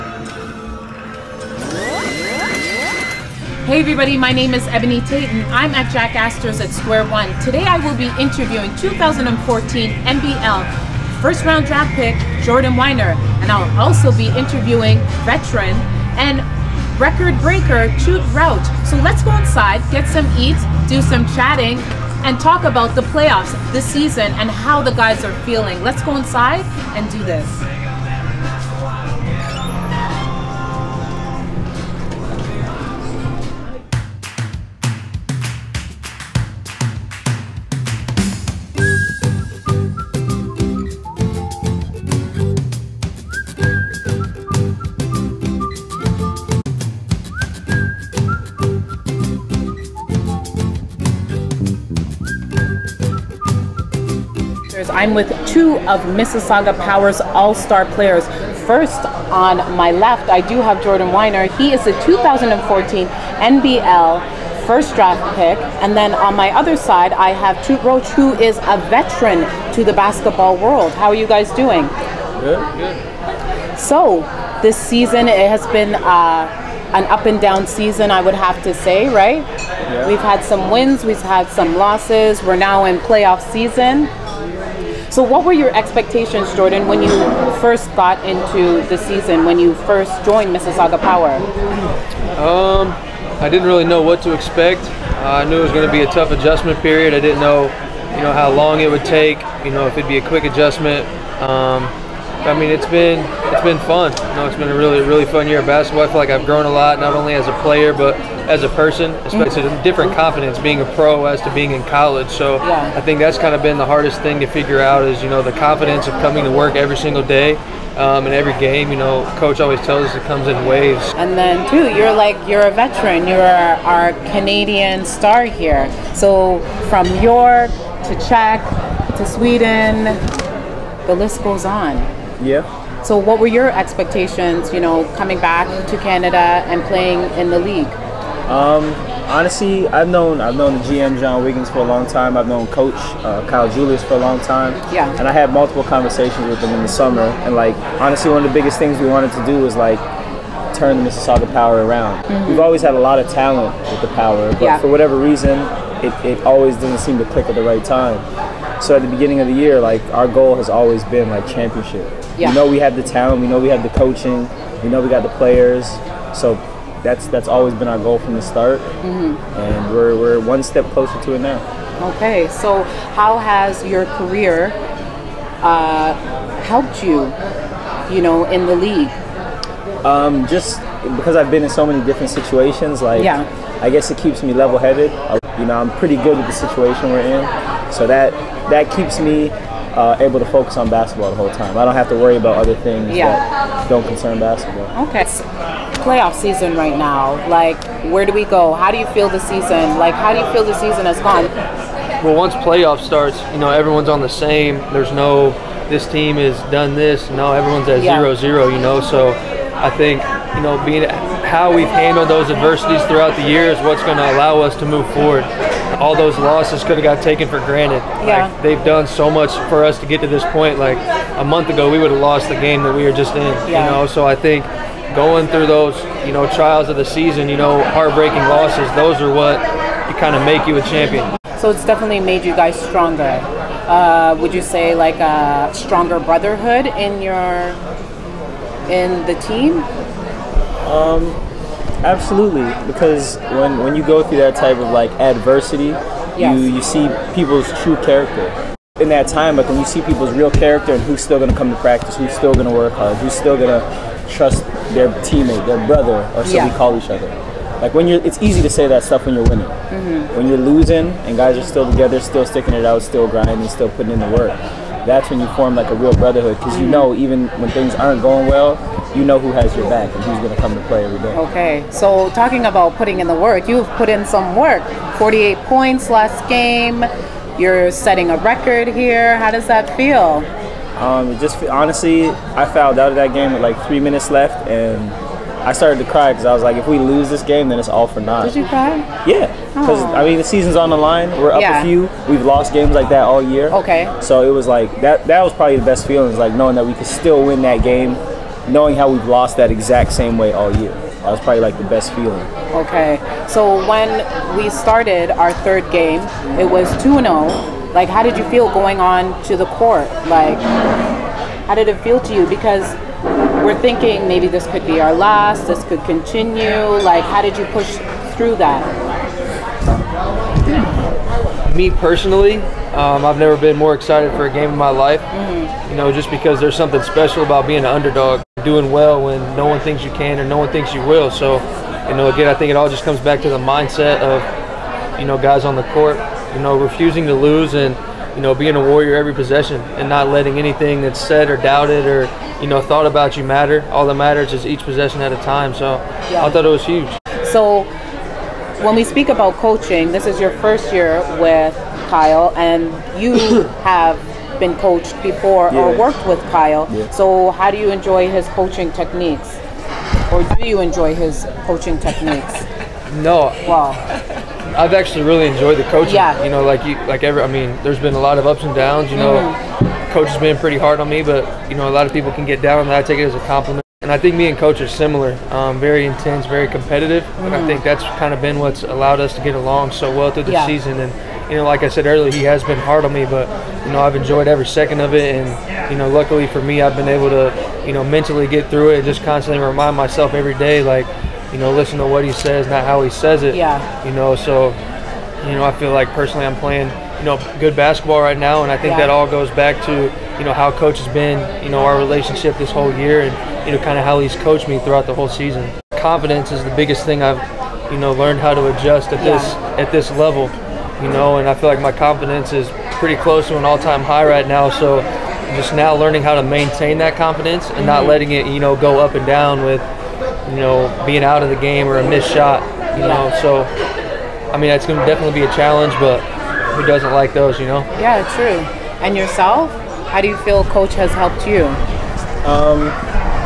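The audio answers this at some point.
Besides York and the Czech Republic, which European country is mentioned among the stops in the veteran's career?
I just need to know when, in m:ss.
2:09.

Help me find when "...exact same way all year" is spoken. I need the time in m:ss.
4:59.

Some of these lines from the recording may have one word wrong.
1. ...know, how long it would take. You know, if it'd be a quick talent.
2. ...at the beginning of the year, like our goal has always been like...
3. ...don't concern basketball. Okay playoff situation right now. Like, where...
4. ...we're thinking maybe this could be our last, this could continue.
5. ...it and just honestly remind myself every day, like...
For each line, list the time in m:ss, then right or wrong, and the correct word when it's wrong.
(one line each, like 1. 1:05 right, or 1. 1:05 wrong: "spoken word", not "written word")
1. 1:38 wrong: "adjustment", not "talent"
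2. 2:38 right
3. 3:13 wrong: "season", not "situation"
4. 5:13 right
5. 6:28 wrong: "constantly", not "honestly".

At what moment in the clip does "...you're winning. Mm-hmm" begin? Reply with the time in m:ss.
4:19.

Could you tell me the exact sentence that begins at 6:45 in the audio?
Confidence is the biggest thing I've, you know, learned how to adjust at yeah.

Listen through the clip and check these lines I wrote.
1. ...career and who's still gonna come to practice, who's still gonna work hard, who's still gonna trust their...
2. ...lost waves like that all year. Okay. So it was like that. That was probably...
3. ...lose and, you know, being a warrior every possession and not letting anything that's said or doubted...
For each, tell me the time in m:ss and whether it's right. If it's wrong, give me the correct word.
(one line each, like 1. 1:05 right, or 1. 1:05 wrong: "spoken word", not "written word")
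1. 4:10 wrong: "character", not "career"
2. 4:52 wrong: "games", not "waves"
3. 5:37 right.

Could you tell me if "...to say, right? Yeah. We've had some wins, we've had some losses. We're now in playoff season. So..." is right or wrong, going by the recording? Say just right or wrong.
right.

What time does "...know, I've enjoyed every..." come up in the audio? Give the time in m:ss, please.
6:23.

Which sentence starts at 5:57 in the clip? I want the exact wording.
So how do you enjoy his coaching techniques?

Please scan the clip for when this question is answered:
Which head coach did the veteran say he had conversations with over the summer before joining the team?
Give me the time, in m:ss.
2:23.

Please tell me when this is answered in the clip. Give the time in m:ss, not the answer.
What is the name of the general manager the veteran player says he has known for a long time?
2:21.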